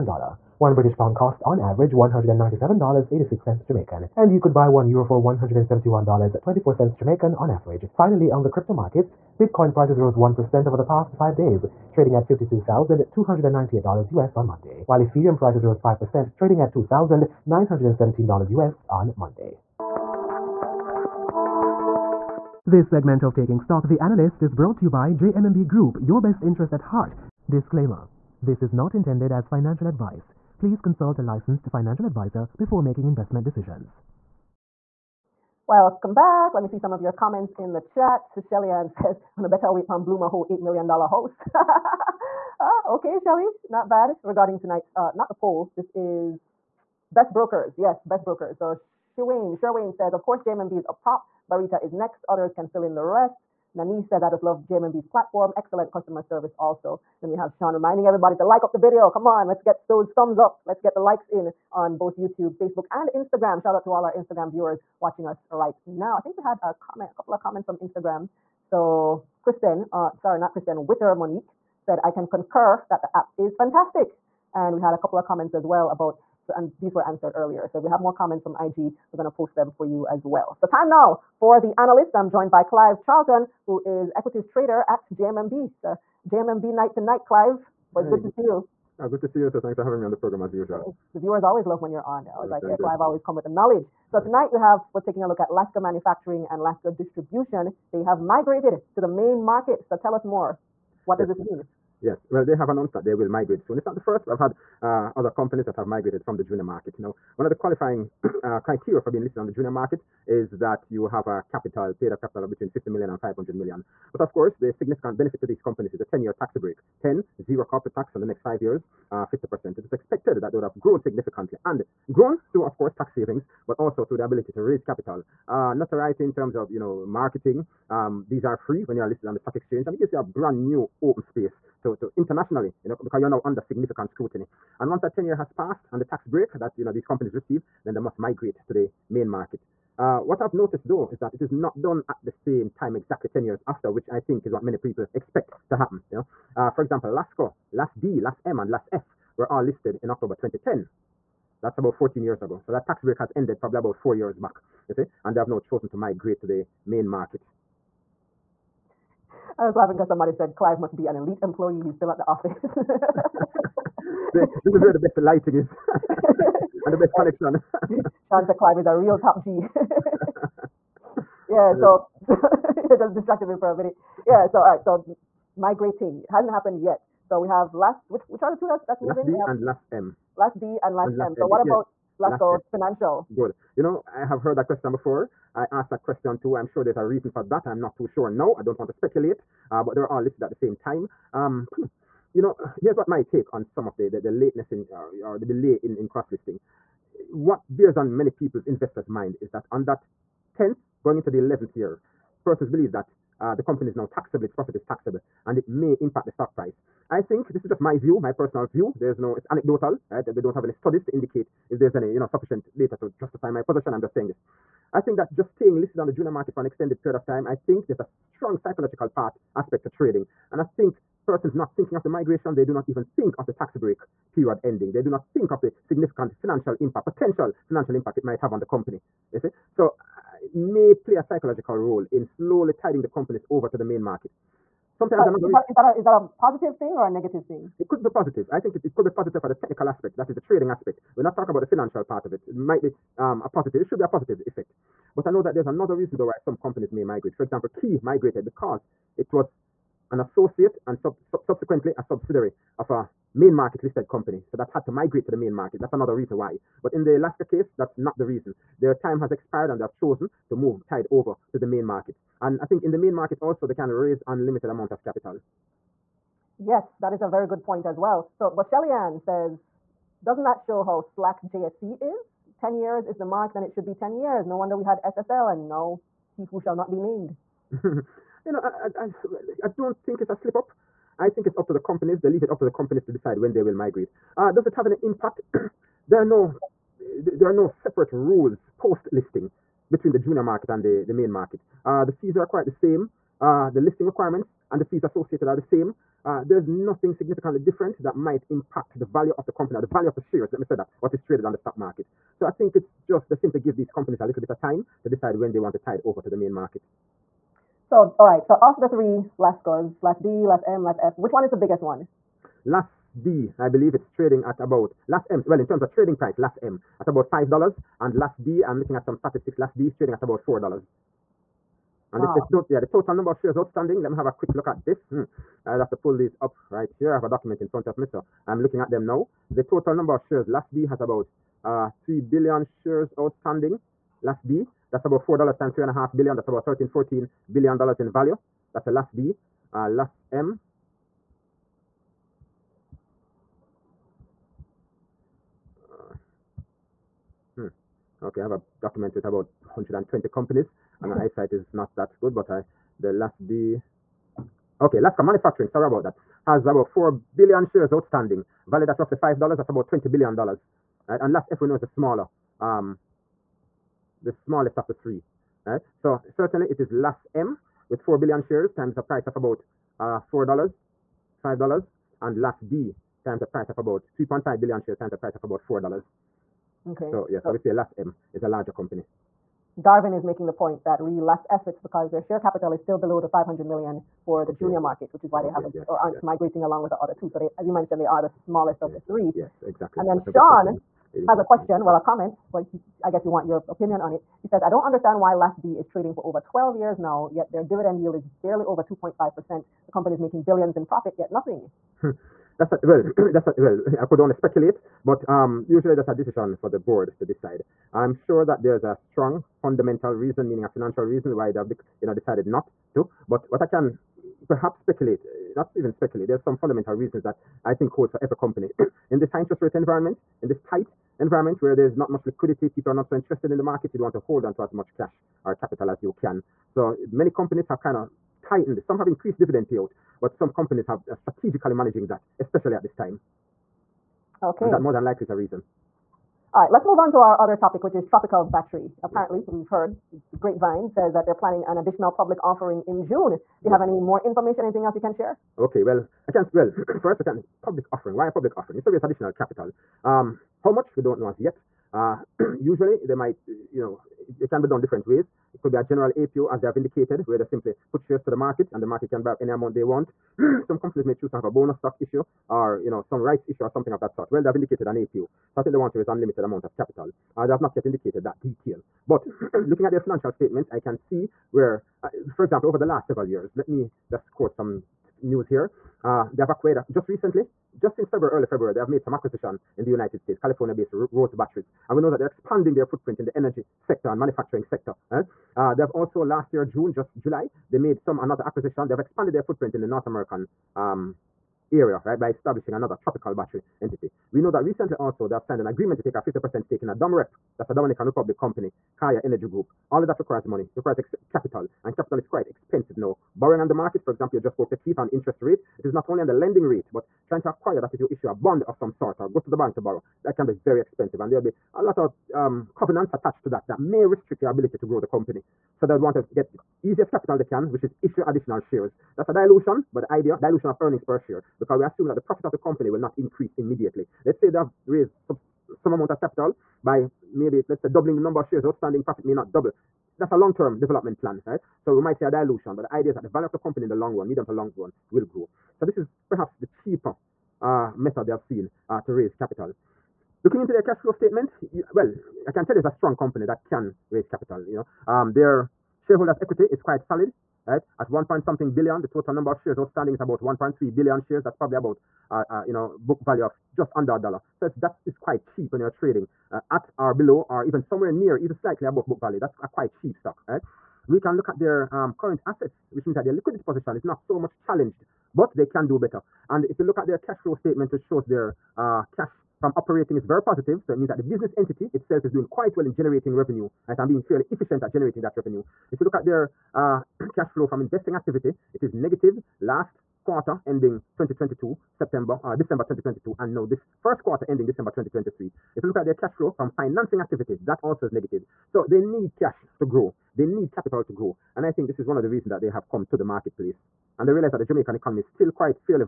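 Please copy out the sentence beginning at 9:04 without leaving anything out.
You know, um, their shareholders' equity is quite solid right?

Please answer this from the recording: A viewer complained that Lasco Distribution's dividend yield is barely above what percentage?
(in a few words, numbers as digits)
2.5%.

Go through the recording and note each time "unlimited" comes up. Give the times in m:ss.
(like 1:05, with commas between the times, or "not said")
4:24, 7:46.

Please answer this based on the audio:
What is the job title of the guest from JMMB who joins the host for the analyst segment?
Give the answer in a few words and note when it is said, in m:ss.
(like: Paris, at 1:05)
Equities trader, at 1:24.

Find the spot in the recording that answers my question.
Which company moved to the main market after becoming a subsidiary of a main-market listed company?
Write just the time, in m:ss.
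4:07.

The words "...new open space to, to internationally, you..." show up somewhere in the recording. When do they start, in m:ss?
2:10.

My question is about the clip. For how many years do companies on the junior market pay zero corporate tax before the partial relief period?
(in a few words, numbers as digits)
10.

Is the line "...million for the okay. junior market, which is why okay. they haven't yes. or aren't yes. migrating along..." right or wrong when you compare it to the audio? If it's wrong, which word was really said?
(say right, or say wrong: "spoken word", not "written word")
right.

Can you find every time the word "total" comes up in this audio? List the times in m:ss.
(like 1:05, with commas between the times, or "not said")
5:22, 5:29, 9:09.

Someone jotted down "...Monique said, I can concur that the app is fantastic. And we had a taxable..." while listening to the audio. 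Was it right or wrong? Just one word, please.
wrong.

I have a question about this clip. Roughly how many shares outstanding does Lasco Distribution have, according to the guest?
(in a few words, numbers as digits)
3 billion.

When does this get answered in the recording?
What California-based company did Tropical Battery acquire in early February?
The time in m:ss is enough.
8:01.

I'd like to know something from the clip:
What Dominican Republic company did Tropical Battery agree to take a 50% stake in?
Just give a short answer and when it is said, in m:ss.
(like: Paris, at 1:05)
Kaya Energy Group, at 8:18.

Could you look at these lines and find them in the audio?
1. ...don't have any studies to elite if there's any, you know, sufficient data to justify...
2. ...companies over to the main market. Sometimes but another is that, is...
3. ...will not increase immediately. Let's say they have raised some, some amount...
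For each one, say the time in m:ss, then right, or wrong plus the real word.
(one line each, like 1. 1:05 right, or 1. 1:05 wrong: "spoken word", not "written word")
1. 3:30 wrong: "indicate", not "elite"
2. 3:53 right
3. 8:42 right.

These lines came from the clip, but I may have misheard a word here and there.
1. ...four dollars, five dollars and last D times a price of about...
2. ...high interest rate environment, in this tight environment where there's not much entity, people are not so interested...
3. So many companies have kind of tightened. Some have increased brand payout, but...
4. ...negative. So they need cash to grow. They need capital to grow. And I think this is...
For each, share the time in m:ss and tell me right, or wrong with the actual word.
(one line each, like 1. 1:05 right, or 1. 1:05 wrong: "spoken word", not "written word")
1. 6:10 right
2. 6:59 wrong: "liquidity", not "entity"
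3. 7:06 wrong: "dividend", not "brand"
4. 9:48 right.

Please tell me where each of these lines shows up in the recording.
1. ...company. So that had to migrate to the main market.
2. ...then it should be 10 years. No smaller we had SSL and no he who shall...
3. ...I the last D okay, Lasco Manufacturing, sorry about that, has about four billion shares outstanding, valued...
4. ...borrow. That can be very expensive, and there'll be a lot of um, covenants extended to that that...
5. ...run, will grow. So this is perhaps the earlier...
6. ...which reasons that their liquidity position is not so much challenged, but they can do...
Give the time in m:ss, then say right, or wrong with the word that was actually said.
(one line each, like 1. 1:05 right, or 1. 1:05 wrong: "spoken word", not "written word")
1. 4:14 right
2. 4:33 wrong: "wonder", not "smaller"
3. 5:52 right
4. 8:29 wrong: "attached", not "extended"
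5. 8:54 wrong: "cheaper", not "earlier"
6. 9:22 wrong: "means", not "reasons".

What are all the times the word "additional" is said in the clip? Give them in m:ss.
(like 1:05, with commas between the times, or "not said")
7:21, 7:29, 8:38.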